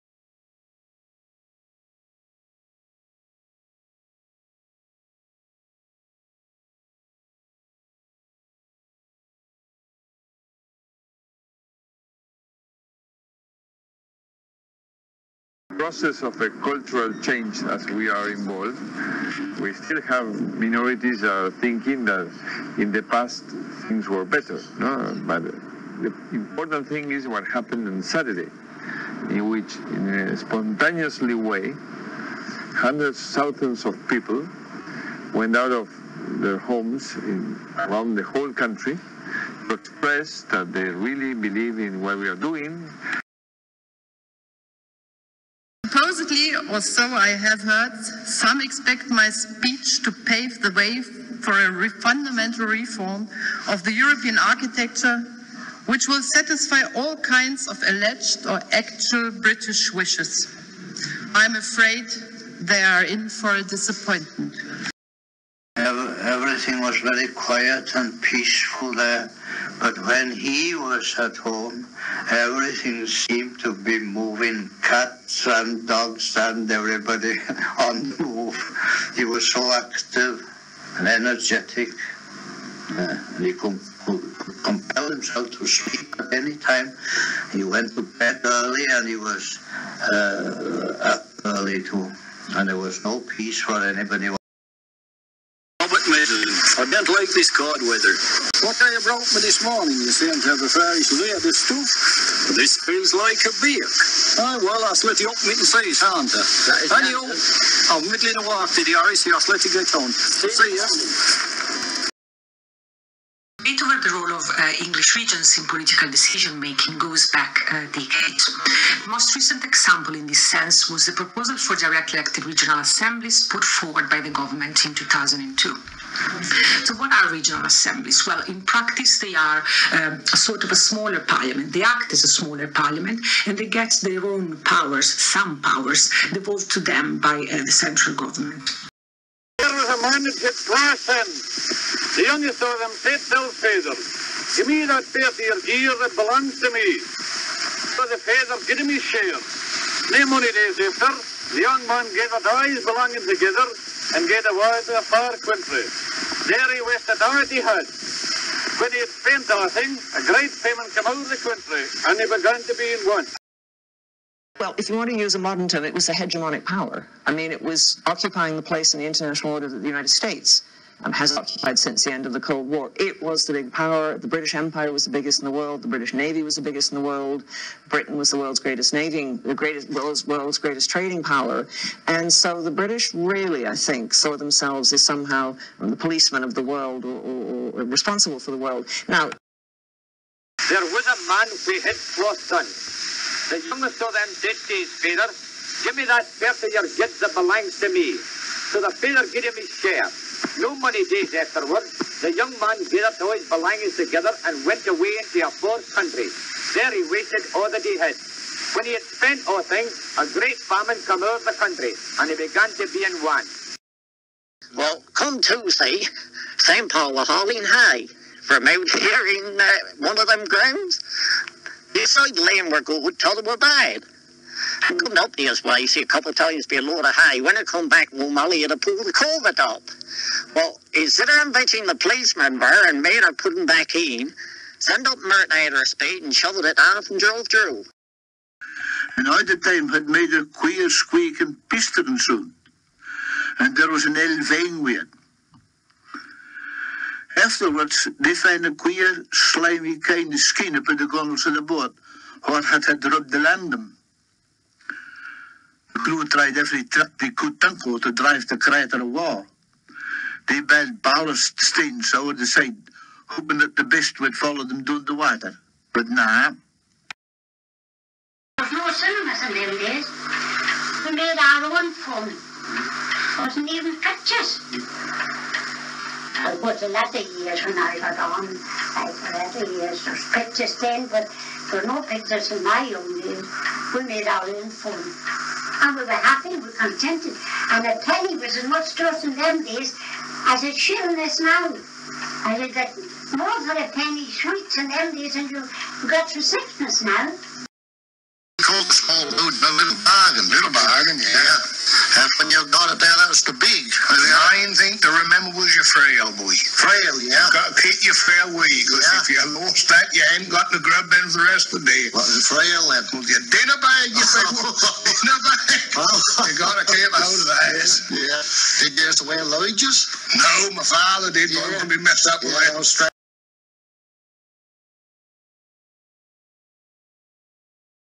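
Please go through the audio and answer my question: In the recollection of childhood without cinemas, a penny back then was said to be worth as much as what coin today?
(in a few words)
a shilling.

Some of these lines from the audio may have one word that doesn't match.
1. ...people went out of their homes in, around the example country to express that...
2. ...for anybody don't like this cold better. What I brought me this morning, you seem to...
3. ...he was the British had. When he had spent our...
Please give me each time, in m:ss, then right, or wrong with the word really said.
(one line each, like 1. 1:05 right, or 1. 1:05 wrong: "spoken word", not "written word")
1. 0:34 wrong: "whole", not "example"
2. 1:33 wrong: "weather", not "better"
3. 2:36 wrong: "Doherty", not "British".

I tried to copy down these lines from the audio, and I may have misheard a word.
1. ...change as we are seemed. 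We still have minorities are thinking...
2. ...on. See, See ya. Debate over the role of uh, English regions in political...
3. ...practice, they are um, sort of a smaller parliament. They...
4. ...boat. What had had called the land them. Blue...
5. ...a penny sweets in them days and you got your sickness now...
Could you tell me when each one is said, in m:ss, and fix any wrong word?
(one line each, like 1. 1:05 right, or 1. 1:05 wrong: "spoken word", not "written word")
1. 0:17 wrong: "involved", not "seemed"
2. 1:49 right
3. 2:08 right
4. 4:11 wrong: "rubbed", not "called"
5. 4:53 right.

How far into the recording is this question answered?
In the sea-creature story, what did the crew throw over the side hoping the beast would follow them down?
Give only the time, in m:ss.
4:21.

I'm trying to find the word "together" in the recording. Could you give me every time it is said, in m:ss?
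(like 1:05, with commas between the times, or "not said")
2:33, 3:23.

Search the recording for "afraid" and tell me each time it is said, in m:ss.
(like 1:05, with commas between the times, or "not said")
1:01.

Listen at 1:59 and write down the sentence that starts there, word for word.
The most recent example in this sense was the proposal for directly elected regional assemblies put forward by the government in 2002.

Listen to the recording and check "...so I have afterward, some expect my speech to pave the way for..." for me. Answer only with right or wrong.
wrong.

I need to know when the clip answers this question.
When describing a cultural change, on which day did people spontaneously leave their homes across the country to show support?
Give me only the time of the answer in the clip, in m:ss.
0:28.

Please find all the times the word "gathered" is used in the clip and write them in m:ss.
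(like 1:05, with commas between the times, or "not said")
2:32, 3:22.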